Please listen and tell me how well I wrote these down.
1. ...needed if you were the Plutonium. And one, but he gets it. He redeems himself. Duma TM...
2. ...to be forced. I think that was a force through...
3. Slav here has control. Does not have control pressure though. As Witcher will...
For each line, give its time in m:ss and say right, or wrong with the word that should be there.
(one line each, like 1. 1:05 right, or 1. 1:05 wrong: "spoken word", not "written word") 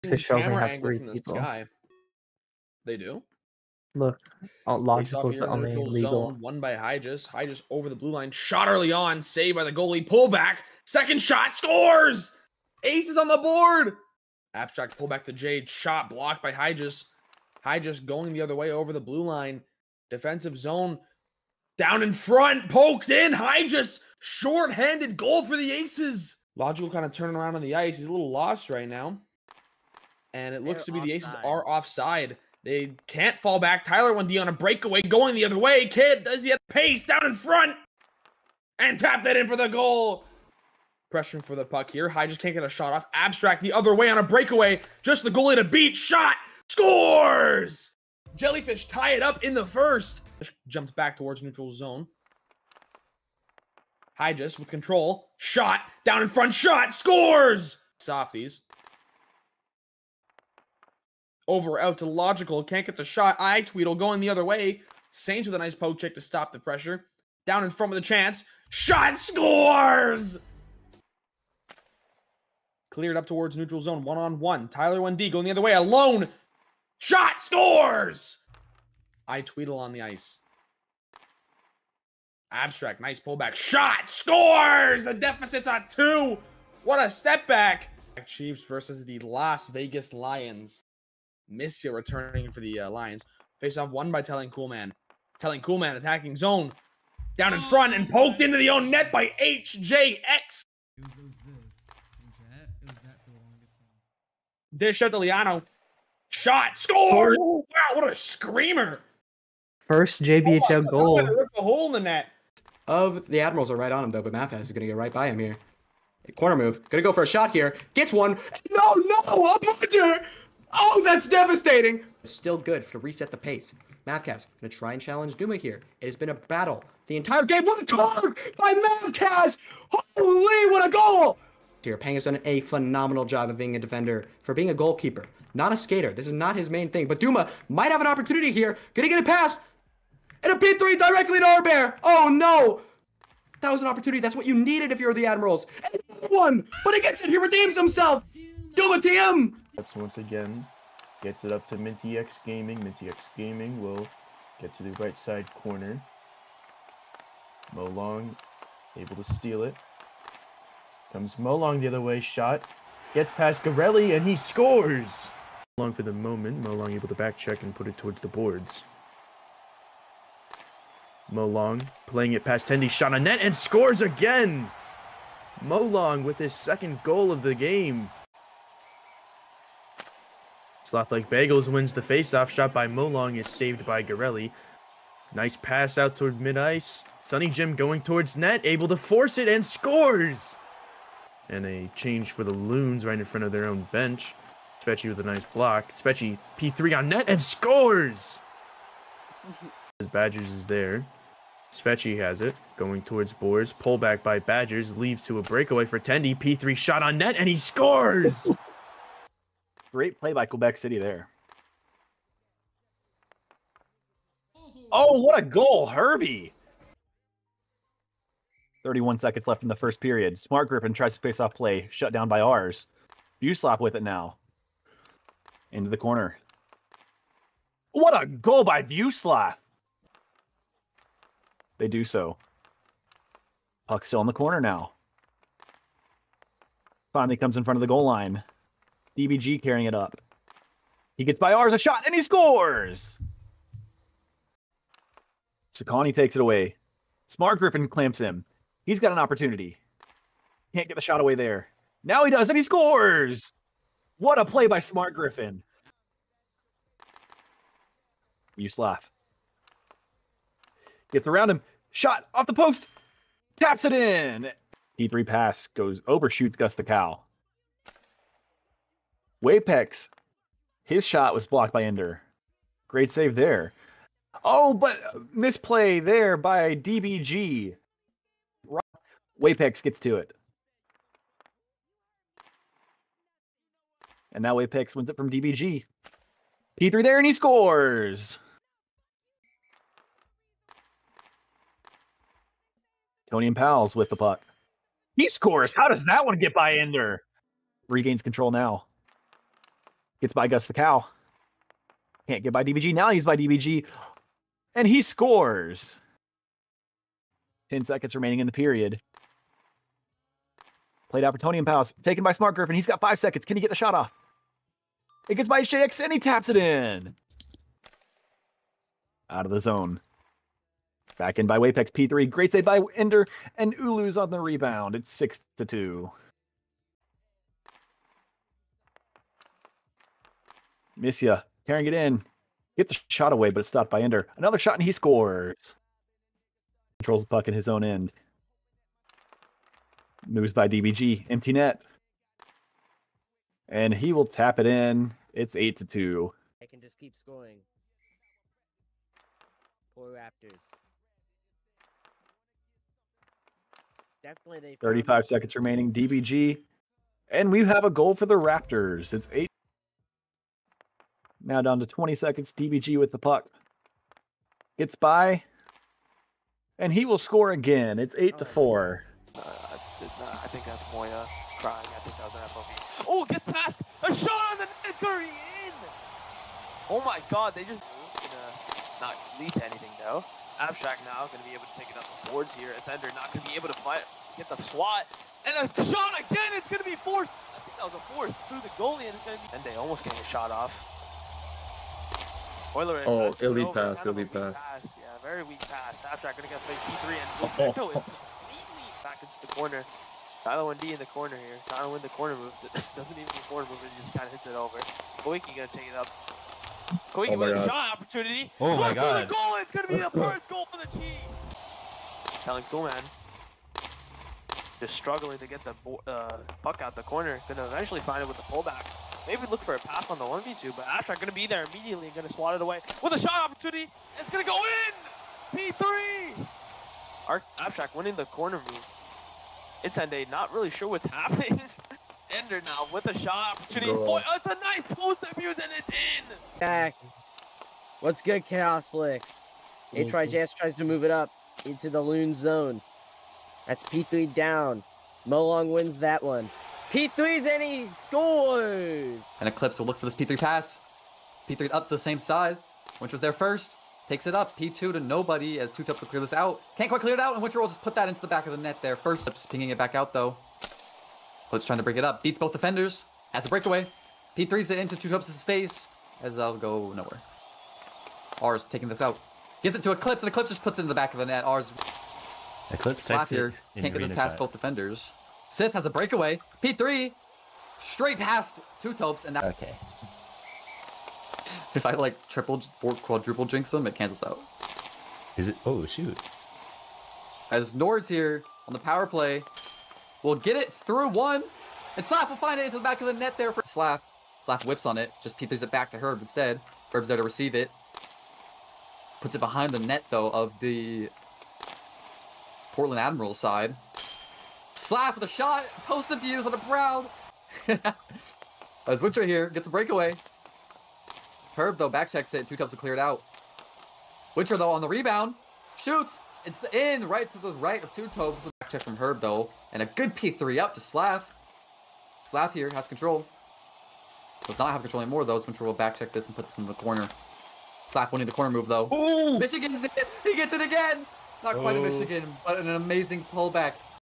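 1. 2:24 wrong: "Admirals", not "Plutonium"
2. 6:26 right
3. 8:42 wrong: "anymore", not "pressure".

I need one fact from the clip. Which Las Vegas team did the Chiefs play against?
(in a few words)
Las Vegas Lions.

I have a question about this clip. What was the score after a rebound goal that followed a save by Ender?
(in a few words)
6 to 2.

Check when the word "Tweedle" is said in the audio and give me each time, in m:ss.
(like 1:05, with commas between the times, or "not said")
1:03, 1:19.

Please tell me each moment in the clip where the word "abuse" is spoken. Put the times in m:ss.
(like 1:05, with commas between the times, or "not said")
7:15, 8:26.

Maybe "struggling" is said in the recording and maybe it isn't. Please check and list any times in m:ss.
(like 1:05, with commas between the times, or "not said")
6:54.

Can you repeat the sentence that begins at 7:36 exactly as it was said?
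Can't quite clear it out, and Winter will just put that into the back of the net there.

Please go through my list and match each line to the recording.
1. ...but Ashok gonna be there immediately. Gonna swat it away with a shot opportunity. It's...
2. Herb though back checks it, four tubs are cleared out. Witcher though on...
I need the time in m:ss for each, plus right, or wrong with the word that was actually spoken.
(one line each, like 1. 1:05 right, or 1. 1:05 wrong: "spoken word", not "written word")
1. 7:00 right
2. 8:31 wrong: "two", not "four".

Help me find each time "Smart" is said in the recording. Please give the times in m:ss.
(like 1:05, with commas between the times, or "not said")
3:40, 4:07, 4:14, 5:12.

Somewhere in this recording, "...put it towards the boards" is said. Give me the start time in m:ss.
2:47.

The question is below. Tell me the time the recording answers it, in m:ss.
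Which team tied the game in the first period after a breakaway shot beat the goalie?
0:48.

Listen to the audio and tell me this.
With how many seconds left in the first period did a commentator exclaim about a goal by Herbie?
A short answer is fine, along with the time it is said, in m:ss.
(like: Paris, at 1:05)
31, at 3:38.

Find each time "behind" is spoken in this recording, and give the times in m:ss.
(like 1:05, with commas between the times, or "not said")
8:19.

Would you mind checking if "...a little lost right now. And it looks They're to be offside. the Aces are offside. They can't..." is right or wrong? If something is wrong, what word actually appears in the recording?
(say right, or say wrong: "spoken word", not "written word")
right.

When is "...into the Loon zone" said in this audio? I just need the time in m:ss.
7:21.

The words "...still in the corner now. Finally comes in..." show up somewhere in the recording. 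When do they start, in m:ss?
3:54.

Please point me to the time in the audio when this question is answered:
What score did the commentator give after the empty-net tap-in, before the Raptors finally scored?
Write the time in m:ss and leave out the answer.
5:45.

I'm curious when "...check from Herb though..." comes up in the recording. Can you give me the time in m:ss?
8:38.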